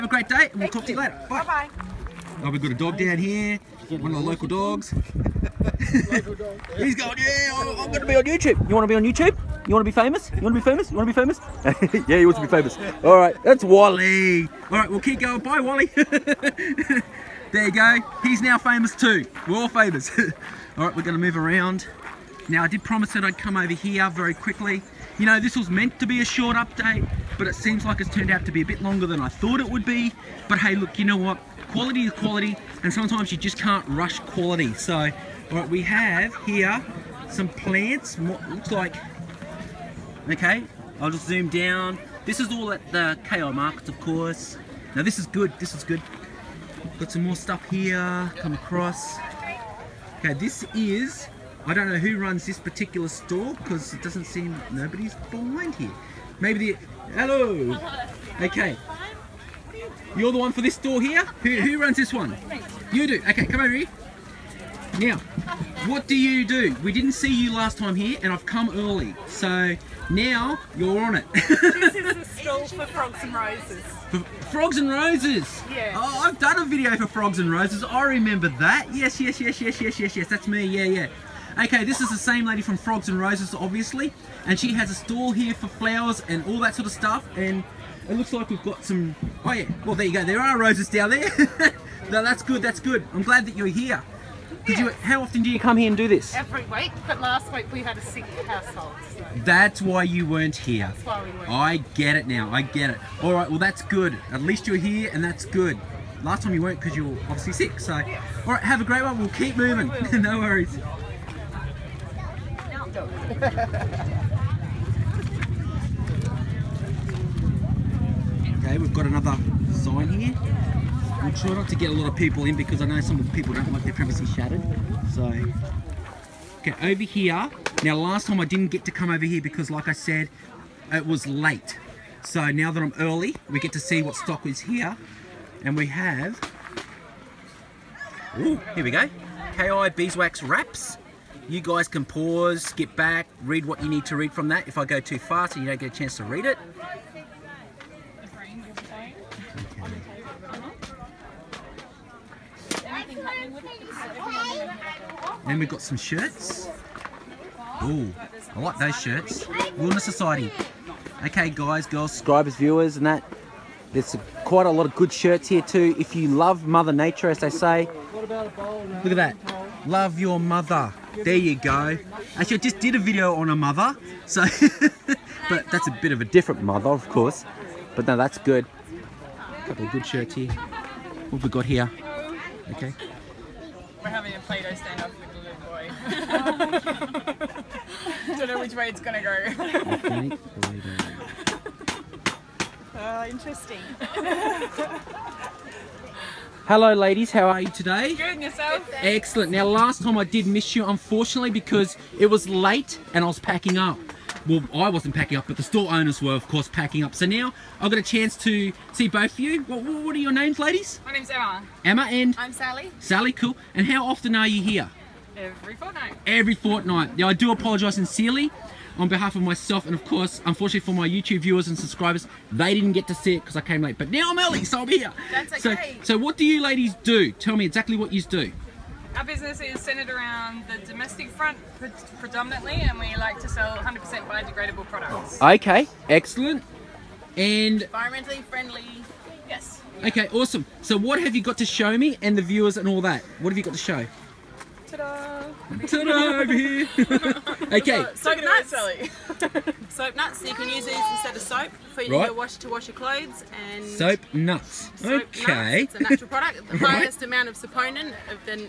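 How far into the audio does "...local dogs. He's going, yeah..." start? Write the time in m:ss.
0:04.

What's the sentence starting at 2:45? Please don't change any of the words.
If you love Mother Nature, as they say, look at that.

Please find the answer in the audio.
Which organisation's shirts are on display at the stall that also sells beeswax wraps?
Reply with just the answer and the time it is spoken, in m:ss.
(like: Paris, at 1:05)
Wilderness Society, at 2:39.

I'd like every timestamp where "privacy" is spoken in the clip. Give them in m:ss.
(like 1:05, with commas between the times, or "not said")
2:03.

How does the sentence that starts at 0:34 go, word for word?
So, right, we have here some plants, looks like, okay, I'll just zoom down.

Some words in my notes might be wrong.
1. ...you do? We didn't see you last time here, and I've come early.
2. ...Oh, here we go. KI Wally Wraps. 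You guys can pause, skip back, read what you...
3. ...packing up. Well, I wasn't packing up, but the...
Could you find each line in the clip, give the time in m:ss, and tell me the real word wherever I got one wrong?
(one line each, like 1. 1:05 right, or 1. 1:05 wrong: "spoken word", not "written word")
1. 1:06 right
2. 2:18 wrong: "Beeswax", not "Wally"
3. 3:23 right.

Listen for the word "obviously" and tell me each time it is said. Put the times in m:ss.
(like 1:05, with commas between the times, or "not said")
1:23, 1:47.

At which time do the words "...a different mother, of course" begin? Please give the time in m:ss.
2:56.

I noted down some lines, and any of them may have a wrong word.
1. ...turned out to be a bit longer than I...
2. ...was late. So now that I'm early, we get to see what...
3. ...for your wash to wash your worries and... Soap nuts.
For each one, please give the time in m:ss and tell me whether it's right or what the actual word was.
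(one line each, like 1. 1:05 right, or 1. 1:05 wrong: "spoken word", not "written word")
1. 0:28 right
2. 2:11 right
3. 4:11 wrong: "clothes", not "worries".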